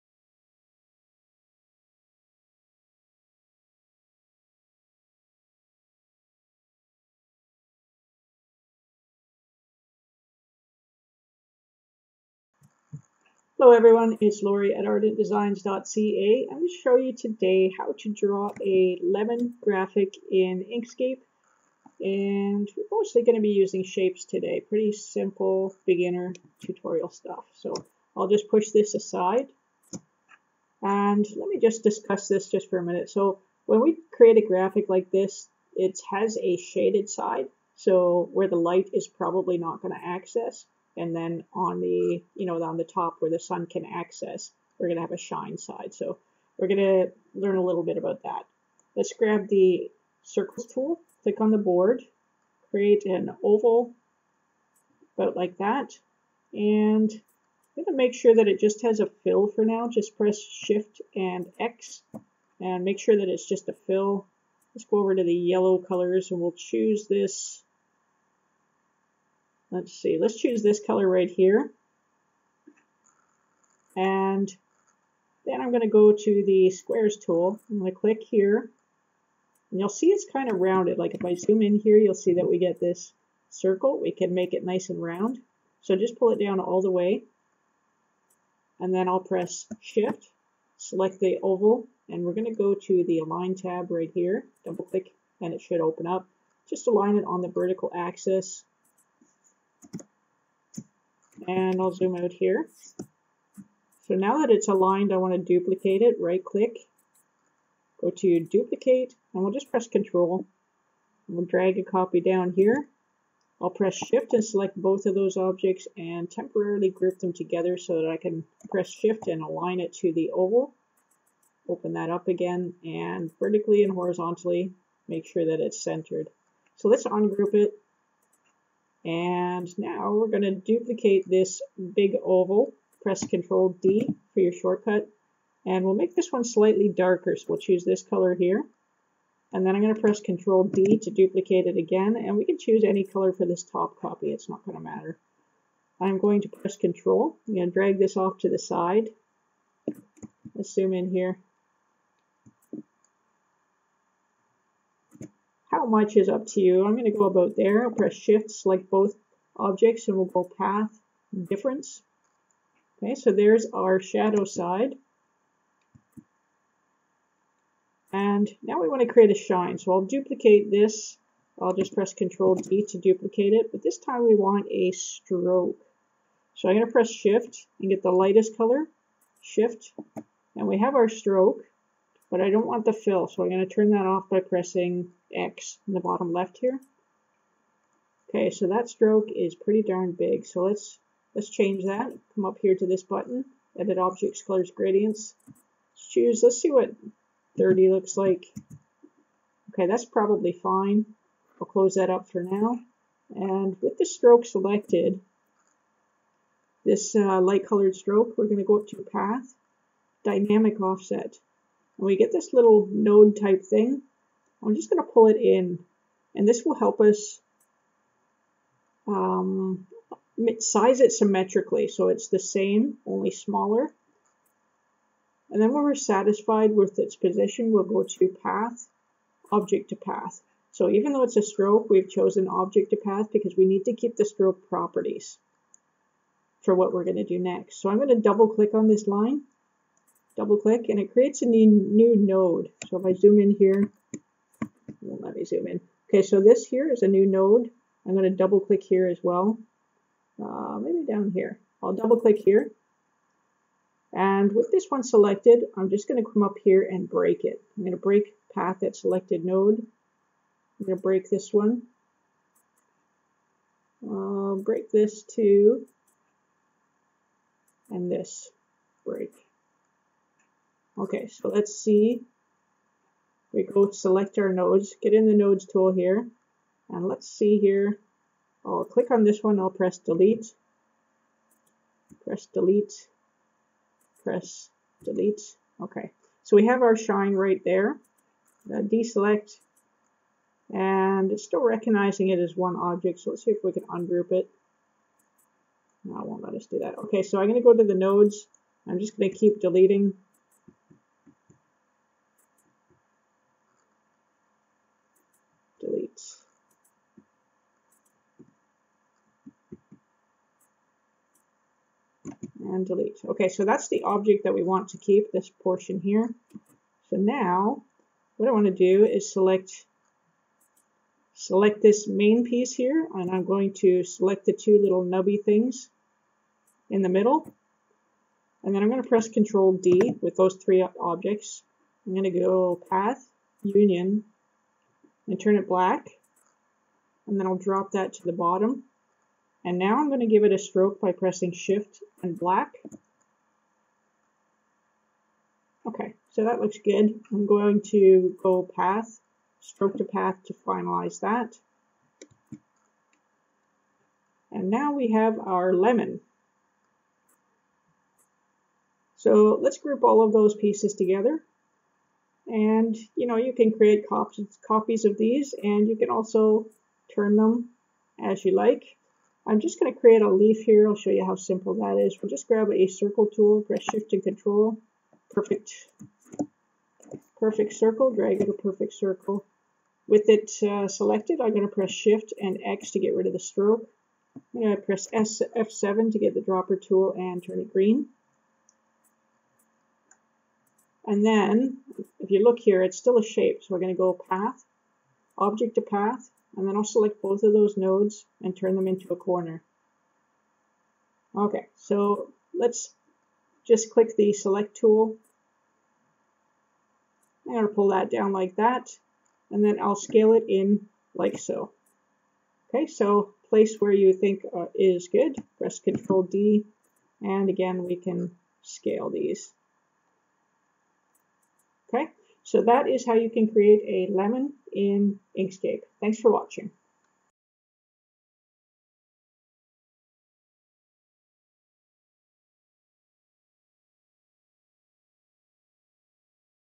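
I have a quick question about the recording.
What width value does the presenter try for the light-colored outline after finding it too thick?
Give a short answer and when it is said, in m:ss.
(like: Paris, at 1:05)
30, at 3:17.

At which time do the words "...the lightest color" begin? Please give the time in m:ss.
2:58.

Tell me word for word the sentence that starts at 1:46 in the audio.
Right click, go to duplicate, and we'll just press control.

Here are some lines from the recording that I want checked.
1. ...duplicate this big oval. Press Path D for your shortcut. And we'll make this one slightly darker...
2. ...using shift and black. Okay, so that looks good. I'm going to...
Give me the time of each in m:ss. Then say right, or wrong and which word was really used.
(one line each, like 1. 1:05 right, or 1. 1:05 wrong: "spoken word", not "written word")
1. 2:10 wrong: "Control", not "Path"
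2. 5:41 wrong: "pressing", not "using".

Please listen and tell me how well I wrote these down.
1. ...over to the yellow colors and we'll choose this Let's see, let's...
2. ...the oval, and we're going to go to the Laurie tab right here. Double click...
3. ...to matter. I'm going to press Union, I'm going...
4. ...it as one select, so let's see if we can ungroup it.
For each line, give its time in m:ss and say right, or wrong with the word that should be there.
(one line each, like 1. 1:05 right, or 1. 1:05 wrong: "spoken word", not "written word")
1. 1:04 right
2. 1:31 wrong: "Align", not "Laurie"
3. 2:24 wrong: "Control", not "Union"
4. 4:52 wrong: "object", not "select".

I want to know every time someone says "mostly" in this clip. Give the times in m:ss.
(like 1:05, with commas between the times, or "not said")
0:22.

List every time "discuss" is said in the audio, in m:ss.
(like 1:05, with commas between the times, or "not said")
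0:31.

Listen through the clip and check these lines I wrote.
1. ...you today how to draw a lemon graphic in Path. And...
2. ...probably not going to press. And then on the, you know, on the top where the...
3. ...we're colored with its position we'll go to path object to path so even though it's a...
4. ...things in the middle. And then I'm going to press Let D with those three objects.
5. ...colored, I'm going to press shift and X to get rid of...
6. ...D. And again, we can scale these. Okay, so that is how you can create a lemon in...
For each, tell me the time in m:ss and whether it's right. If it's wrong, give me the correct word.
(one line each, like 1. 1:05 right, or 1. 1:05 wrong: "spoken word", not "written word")
1. 0:16 wrong: "Inkscape", not "Path"
2. 0:39 wrong: "access", not "press"
3. 3:45 wrong: "satisfied", not "colored"
4. 5:25 wrong: "Control", not "Let"
5. 6:20 wrong: "selected", not "colored"
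6. 6:56 right.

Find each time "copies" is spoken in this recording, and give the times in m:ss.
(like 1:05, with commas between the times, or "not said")
6:04.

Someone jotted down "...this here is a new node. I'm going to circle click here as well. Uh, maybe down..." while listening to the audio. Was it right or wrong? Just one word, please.
wrong.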